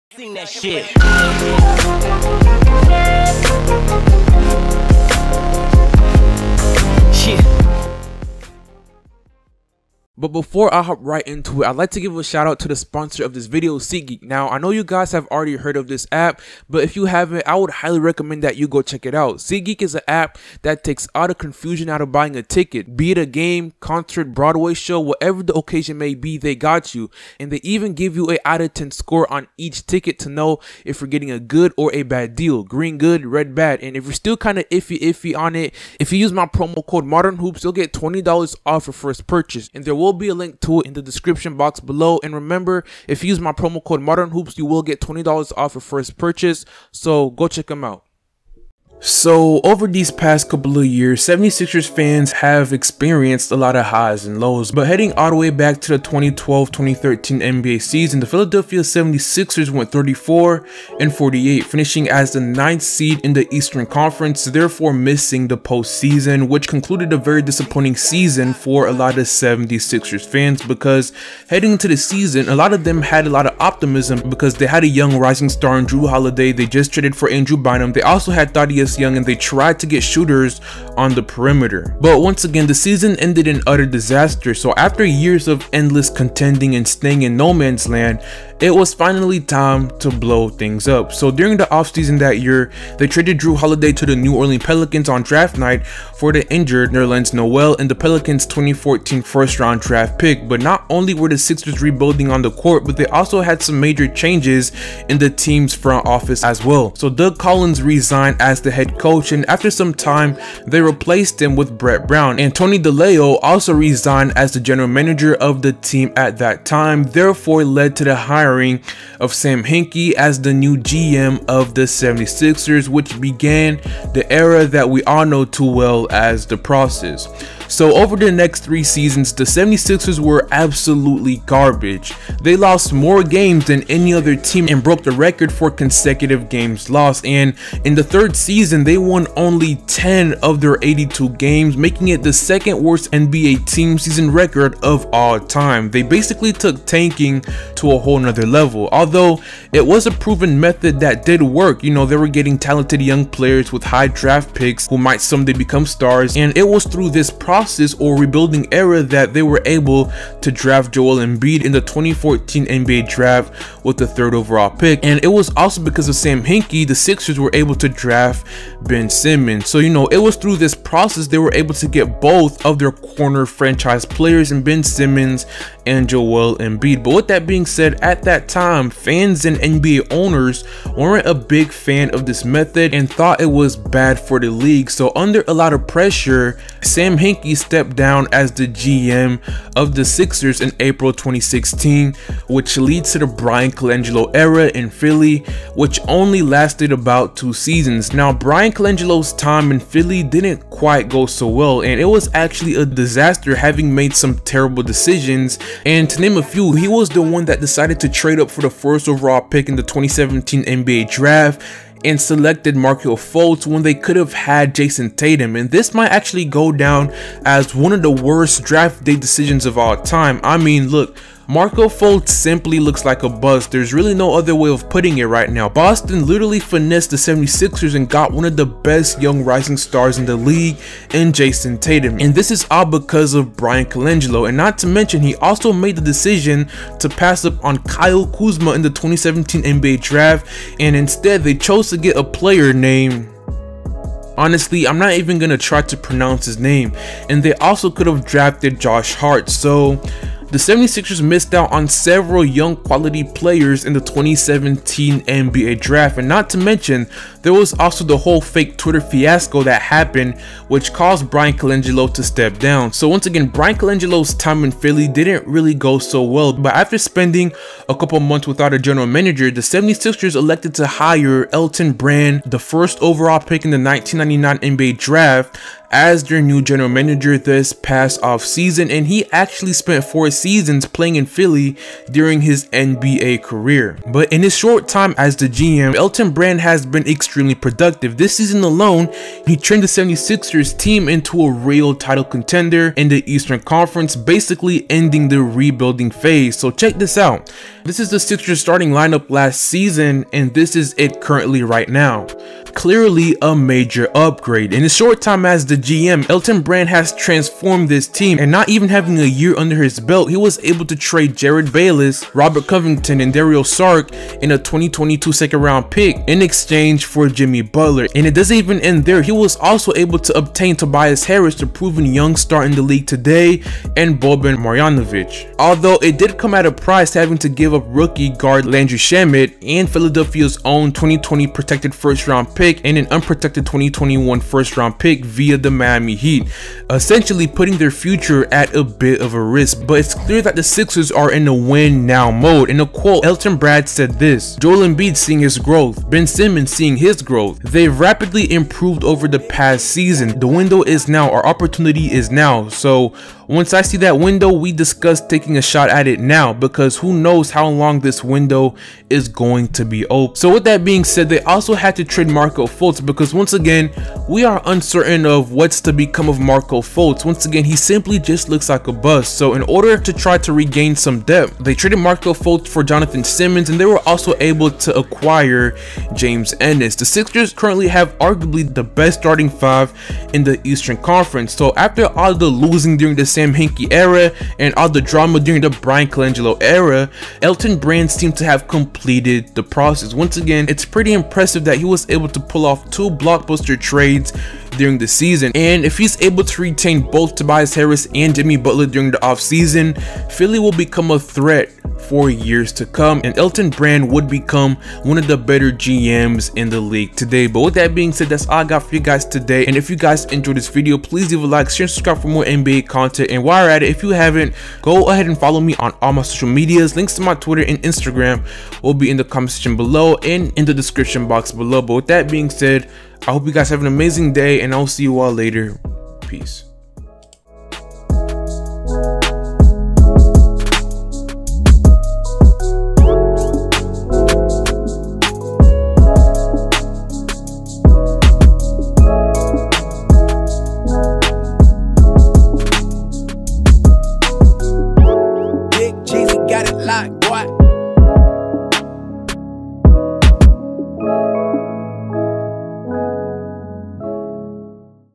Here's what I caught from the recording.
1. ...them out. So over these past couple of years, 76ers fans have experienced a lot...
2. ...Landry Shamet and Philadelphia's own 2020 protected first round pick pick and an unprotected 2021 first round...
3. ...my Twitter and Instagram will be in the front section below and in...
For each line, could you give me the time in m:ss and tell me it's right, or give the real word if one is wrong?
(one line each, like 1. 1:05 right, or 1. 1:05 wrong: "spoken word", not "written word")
1. 0:47 right
2. 5:28 right
3. 6:57 wrong: "comment", not "front".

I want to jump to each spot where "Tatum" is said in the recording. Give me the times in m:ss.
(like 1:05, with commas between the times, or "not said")
3:35, 3:51.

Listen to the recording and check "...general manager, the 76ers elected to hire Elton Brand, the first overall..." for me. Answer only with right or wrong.
right.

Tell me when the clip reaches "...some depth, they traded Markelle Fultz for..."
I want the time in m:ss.
6:10.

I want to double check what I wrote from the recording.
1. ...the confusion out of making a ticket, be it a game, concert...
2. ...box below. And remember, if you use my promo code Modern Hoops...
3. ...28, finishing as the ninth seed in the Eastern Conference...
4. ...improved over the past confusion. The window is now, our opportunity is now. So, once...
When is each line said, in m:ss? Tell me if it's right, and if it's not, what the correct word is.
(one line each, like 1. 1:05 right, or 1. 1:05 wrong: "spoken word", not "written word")
1. 0:21 wrong: "buying", not "making"
2. 0:41 right
3. 1:01 wrong: "48", not "28"
4. 5:48 wrong: "season", not "confusion".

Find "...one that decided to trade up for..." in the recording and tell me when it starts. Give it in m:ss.
3:27.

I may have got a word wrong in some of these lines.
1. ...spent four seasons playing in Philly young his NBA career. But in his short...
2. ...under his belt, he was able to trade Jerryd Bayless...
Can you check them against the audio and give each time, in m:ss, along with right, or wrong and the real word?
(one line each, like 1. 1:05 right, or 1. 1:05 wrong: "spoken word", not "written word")
1. 4:39 wrong: "during", not "young"
2. 5:09 right.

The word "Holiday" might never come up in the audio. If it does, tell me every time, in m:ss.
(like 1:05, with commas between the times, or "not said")
1:16, 1:33.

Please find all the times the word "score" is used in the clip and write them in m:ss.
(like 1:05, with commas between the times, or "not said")
0:28.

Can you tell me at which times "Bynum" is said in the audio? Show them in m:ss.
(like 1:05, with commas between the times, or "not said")
1:17.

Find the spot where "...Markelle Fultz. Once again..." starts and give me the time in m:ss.
6:06.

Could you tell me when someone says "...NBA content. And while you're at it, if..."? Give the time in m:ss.
6:52.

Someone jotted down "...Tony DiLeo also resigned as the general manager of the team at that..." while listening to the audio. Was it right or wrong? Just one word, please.
right.